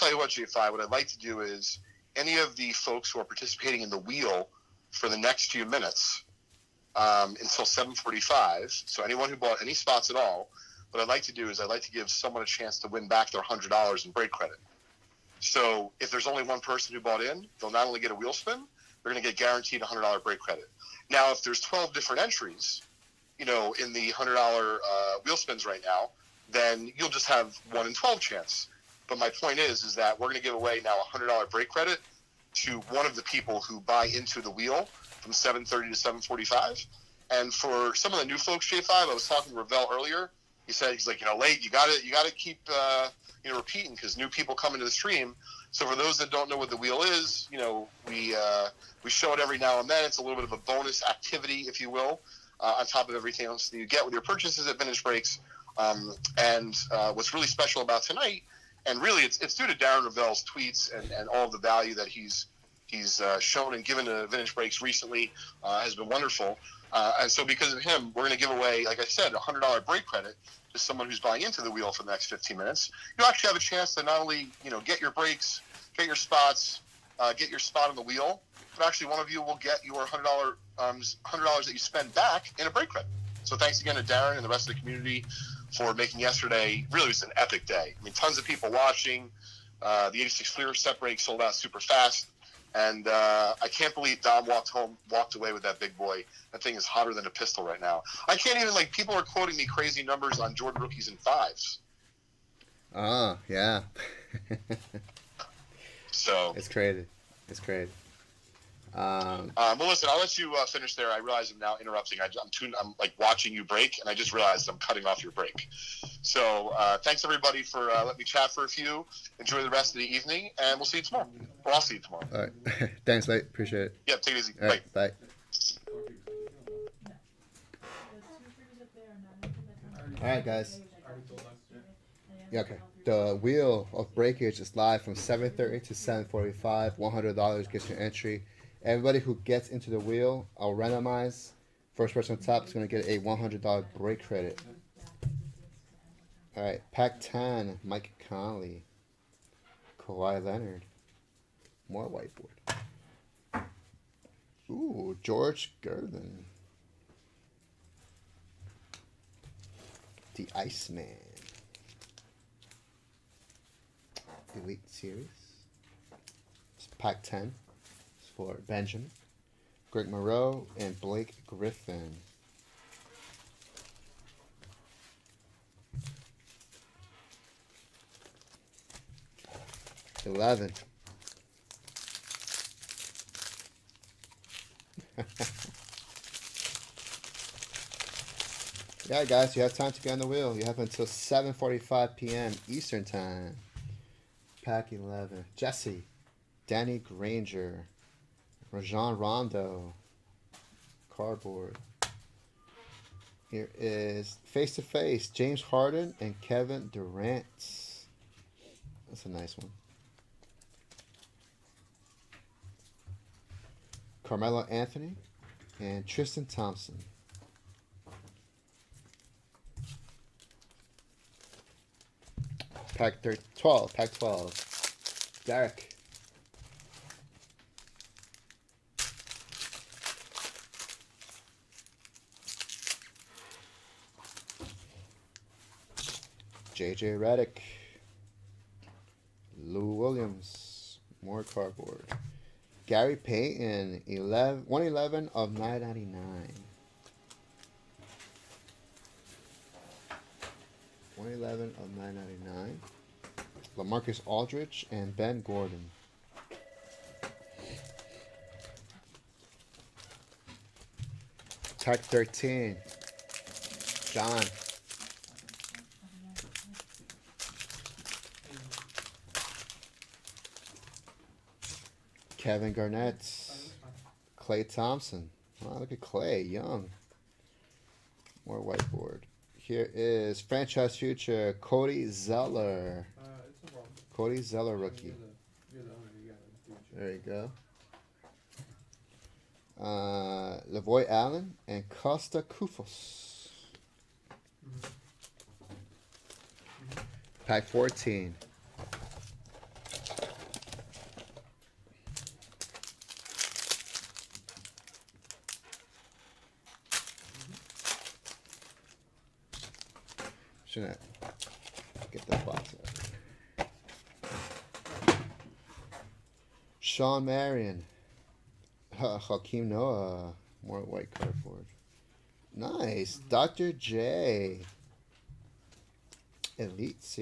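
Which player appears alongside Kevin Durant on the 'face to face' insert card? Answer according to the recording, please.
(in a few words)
James Harden.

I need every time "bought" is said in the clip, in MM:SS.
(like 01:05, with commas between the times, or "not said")
00:09, 00:17.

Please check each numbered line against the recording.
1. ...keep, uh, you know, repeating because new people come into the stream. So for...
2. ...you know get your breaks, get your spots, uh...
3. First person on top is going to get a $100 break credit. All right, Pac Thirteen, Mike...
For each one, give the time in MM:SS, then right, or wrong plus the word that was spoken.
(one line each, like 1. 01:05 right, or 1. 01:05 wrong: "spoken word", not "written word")
1. 00:42 right
2. 01:14 right
3. 02:21 wrong: "Ten", not "Thirteen".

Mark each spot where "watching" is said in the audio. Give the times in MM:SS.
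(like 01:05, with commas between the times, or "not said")
01:28, 01:53.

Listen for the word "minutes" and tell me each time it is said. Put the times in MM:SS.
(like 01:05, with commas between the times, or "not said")
00:05, 01:12.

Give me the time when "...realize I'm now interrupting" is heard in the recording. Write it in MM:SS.
01:51.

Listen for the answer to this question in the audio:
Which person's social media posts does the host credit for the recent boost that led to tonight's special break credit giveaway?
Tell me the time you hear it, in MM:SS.
00:59.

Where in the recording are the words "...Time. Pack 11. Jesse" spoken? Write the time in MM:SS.
03:13.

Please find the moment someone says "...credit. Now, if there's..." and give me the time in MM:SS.
00:20.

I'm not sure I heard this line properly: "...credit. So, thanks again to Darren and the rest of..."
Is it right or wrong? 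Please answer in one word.
right.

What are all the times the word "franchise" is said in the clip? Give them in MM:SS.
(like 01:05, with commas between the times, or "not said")
04:40.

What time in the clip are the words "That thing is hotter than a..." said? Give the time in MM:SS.
01:36.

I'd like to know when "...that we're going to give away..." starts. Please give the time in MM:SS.
00:29.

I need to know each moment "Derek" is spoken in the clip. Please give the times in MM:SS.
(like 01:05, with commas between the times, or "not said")
03:45.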